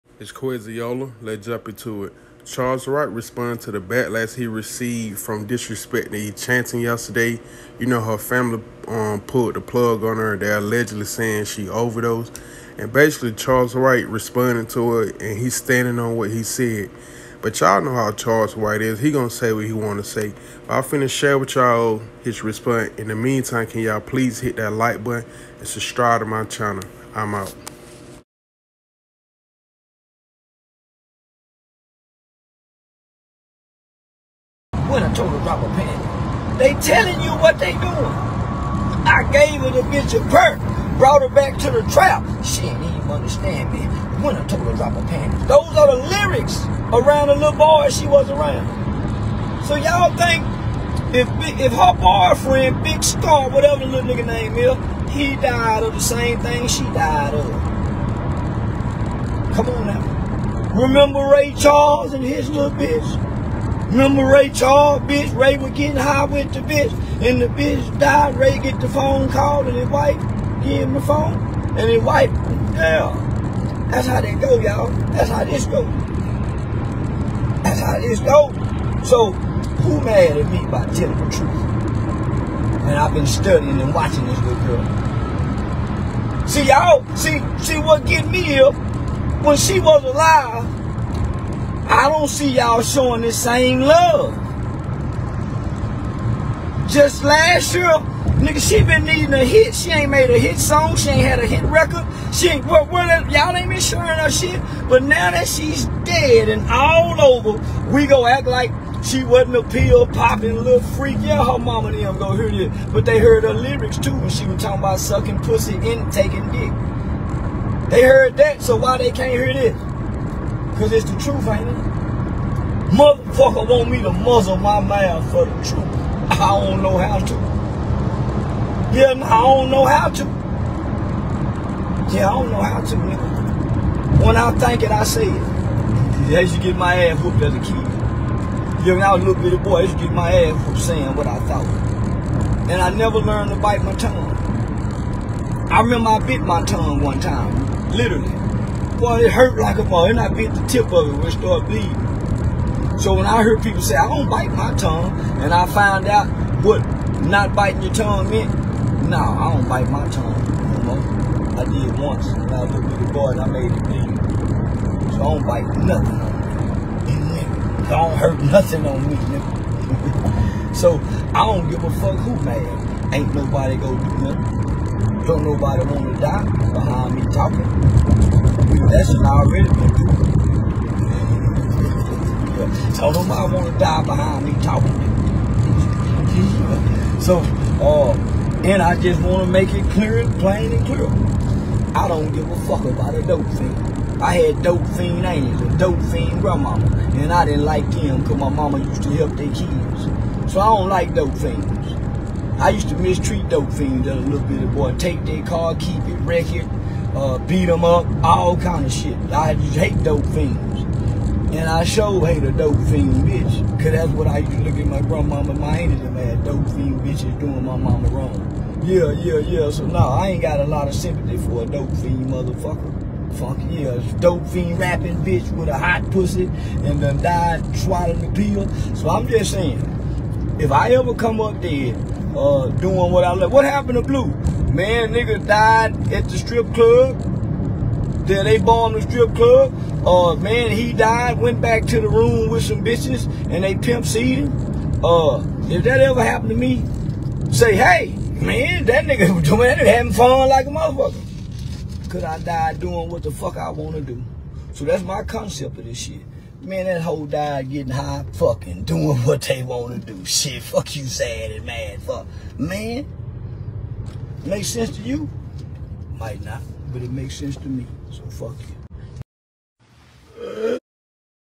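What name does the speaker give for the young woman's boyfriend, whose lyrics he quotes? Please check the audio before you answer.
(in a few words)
Big Scarr.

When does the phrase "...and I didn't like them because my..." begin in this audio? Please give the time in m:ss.
3:17.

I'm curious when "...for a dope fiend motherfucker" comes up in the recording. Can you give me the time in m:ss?
3:41.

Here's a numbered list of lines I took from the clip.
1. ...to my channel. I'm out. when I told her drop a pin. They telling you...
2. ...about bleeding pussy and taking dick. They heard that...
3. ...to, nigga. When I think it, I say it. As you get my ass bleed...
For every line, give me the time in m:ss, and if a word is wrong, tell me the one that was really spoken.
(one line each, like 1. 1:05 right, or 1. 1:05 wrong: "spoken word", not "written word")
1. 0:26 right
2. 1:54 wrong: "sucking", not "bleeding"
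3. 2:12 wrong: "whooped", not "bleed".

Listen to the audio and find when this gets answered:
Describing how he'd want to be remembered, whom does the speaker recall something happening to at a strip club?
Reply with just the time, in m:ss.
3:54.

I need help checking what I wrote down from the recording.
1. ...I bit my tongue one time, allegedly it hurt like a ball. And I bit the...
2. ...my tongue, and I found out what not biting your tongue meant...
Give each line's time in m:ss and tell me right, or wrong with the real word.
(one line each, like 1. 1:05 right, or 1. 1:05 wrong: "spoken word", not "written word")
1. 2:26 wrong: "literally", not "allegedly"
2. 2:34 right.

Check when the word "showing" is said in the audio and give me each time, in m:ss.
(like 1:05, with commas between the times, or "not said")
1:32, 1:43.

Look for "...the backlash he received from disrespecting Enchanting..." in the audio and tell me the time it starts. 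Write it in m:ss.
0:03.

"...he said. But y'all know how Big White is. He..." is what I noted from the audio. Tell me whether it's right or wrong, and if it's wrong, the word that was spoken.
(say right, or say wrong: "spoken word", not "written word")
wrong: "Charleston", not "Big".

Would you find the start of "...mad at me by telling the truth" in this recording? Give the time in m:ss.
1:20.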